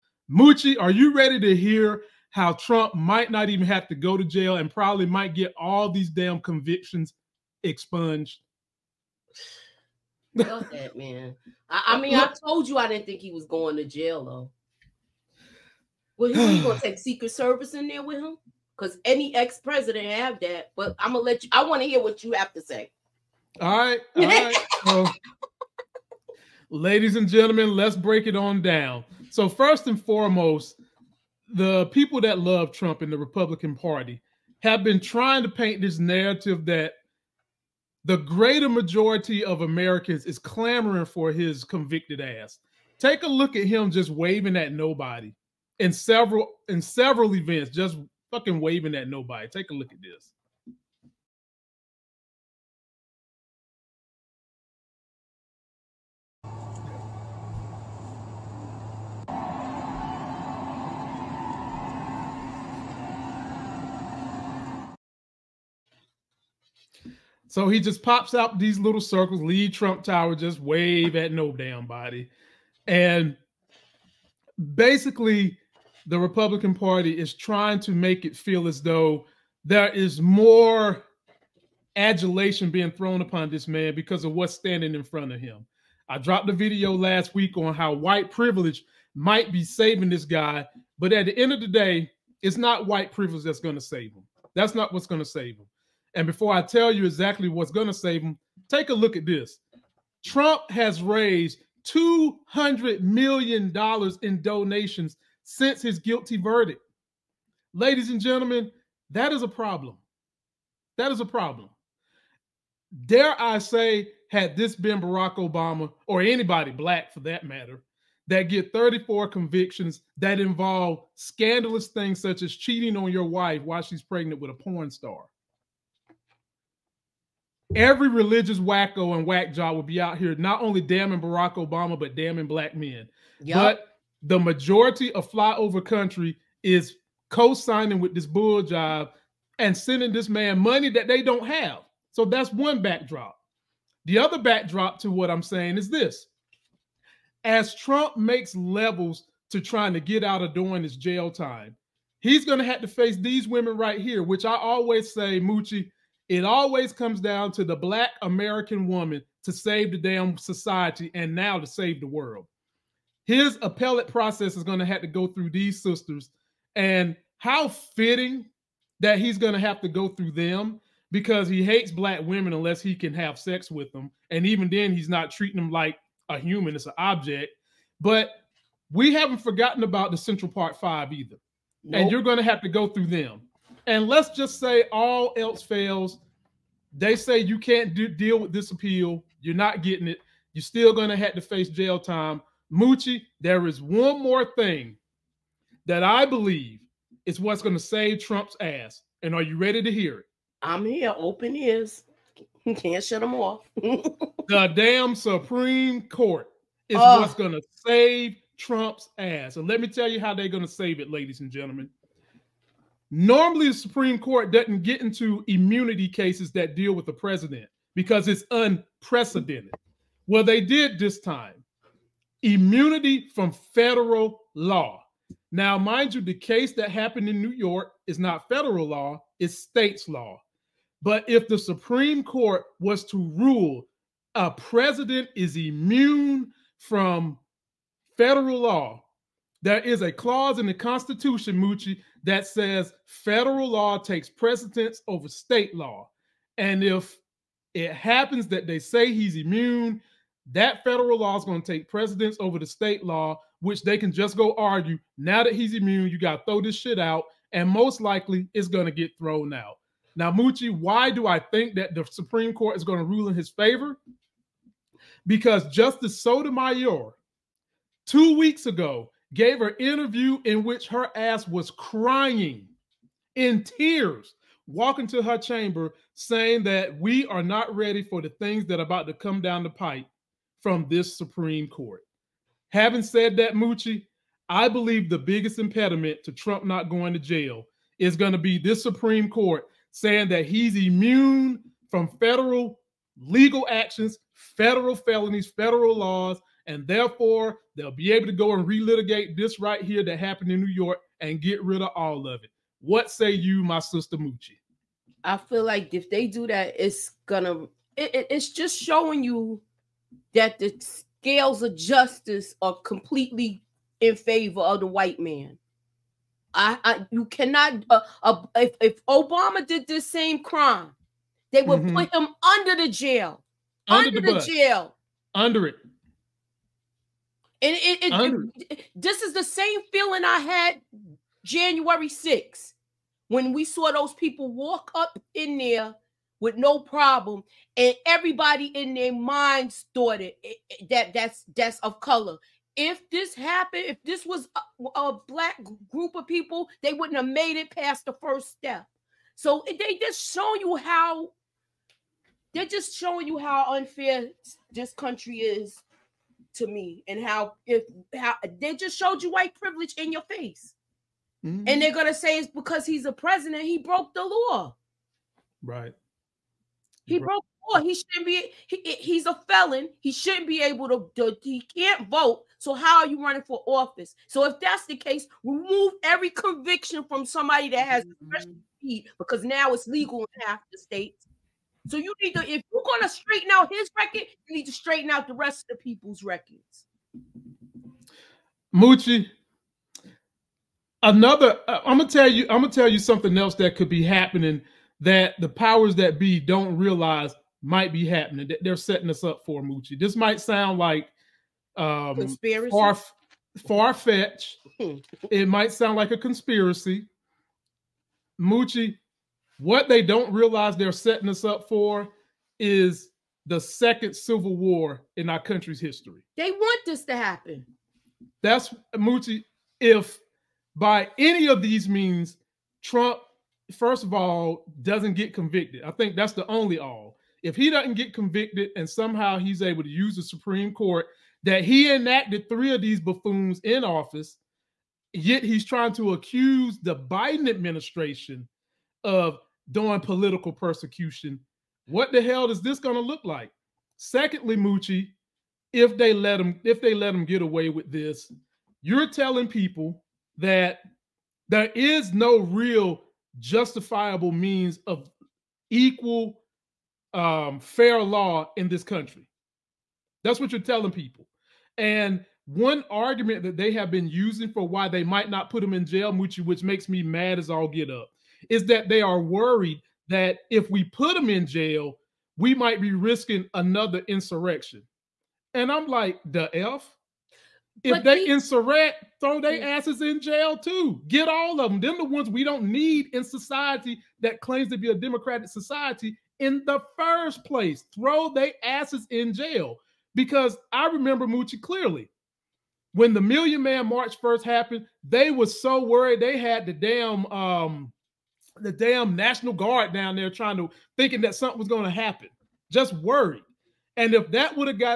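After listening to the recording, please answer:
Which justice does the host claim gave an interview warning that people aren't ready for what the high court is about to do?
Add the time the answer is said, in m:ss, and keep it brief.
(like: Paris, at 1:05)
Sotomayor, at 4:26.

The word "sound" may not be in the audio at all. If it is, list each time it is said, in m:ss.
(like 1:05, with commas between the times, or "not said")
6:40, 6:45.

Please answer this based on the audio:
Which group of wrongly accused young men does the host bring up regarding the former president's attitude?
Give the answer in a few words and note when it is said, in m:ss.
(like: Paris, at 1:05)
Central Park 5, at 3:00.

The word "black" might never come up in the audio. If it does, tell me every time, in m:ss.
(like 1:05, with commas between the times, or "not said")
1:56, 2:12, 2:37, 2:51, 5:45.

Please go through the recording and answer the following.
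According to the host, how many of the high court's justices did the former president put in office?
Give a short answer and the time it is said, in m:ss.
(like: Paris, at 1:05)
3, at 7:12.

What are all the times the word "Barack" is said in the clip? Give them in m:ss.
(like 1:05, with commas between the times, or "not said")
1:54, 2:11.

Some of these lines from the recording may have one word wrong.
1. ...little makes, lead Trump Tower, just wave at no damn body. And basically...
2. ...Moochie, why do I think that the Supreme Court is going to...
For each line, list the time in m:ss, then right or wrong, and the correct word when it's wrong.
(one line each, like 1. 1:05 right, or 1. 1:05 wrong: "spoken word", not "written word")
1. 1:08 wrong: "circles", not "makes"
2. 4:20 right.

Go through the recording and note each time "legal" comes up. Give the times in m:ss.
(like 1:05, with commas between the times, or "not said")
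4:53, 6:19.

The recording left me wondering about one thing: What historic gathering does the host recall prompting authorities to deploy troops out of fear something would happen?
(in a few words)
Million Man March.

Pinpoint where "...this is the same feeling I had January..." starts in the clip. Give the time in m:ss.
5:28.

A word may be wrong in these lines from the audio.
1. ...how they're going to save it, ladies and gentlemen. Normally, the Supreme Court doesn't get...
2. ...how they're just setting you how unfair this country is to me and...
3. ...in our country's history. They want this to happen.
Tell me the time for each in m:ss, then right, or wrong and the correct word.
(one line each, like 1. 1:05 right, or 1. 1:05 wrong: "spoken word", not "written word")
1. 3:30 right
2. 5:50 wrong: "showing", not "setting"
3. 6:55 right.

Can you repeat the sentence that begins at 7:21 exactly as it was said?
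What the hell is this going to look like?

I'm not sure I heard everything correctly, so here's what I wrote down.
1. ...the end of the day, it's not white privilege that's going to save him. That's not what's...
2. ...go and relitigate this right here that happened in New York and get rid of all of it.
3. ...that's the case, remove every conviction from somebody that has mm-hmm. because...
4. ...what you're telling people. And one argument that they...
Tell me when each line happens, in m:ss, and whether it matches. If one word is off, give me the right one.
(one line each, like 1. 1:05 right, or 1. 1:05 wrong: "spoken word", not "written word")
1. 1:31 right
2. 4:58 right
3. 6:14 right
4. 7:40 right.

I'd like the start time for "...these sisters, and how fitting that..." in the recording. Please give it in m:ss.
2:45.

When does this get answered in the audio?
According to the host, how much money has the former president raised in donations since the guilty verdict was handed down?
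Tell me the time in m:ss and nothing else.
1:41.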